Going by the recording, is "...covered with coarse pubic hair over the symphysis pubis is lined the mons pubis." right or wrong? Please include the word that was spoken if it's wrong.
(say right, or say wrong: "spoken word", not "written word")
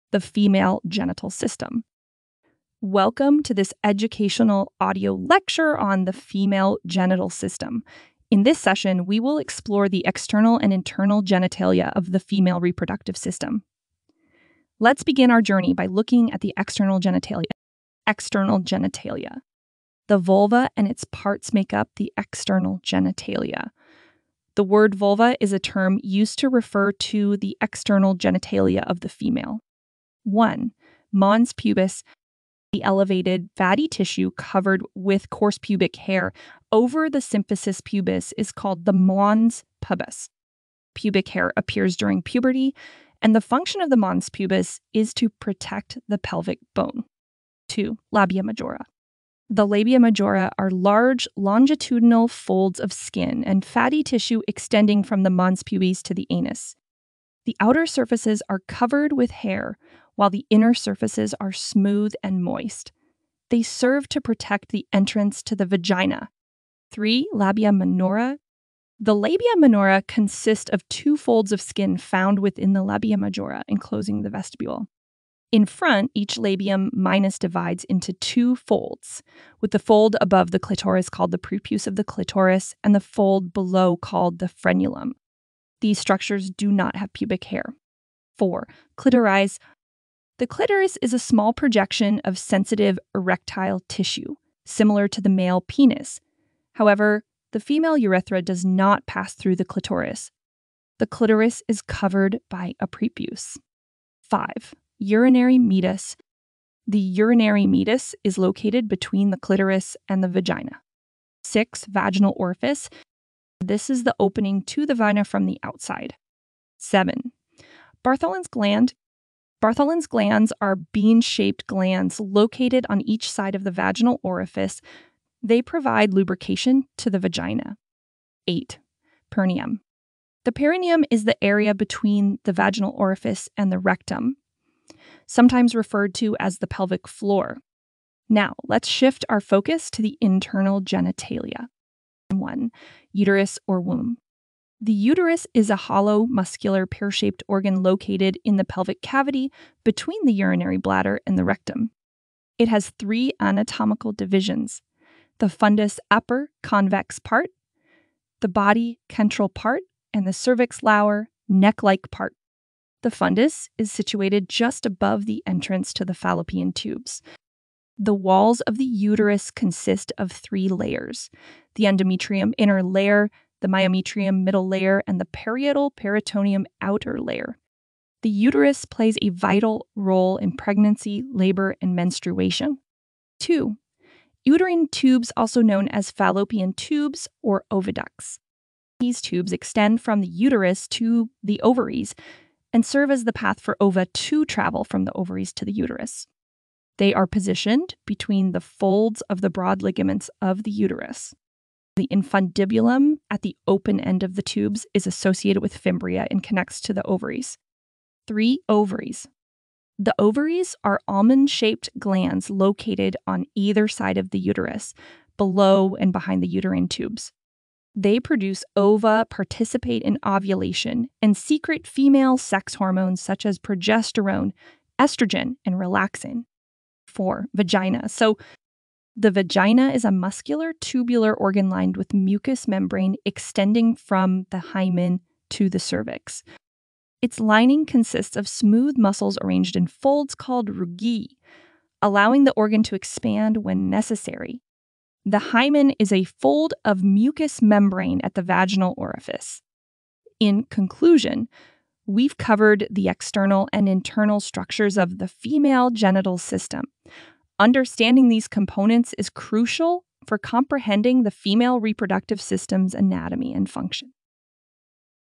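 wrong: "called", not "lined".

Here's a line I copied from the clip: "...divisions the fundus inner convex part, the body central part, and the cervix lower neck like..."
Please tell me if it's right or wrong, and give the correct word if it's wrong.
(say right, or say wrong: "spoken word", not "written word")
wrong: "upper", not "inner".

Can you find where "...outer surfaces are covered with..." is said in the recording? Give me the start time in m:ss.
0:57.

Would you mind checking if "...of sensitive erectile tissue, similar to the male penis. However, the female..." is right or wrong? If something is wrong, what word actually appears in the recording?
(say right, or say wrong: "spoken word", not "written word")
right.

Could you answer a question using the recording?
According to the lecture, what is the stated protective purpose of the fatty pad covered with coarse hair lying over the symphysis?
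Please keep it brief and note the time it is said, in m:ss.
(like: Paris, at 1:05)
Protect the pelvic bone, at 0:45.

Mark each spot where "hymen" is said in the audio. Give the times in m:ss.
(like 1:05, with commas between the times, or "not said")
3:54, 4:05.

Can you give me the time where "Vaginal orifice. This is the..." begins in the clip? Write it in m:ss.
1:51.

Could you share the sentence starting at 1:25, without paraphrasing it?
These structures do not have pubic hair.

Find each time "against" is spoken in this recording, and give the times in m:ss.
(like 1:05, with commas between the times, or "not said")
not said.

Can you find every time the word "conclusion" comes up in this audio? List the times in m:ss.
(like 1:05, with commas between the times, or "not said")
4:10.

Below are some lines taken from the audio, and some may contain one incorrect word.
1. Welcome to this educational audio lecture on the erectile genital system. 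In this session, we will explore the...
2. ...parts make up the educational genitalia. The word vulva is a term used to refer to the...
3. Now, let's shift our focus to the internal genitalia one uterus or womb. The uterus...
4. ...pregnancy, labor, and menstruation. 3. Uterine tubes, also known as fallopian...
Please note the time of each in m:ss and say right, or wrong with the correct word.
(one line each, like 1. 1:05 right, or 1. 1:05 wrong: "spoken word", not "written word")
1. 0:02 wrong: "female", not "erectile"
2. 0:21 wrong: "external", not "educational"
3. 2:18 right
4. 3:00 wrong: "2", not "3".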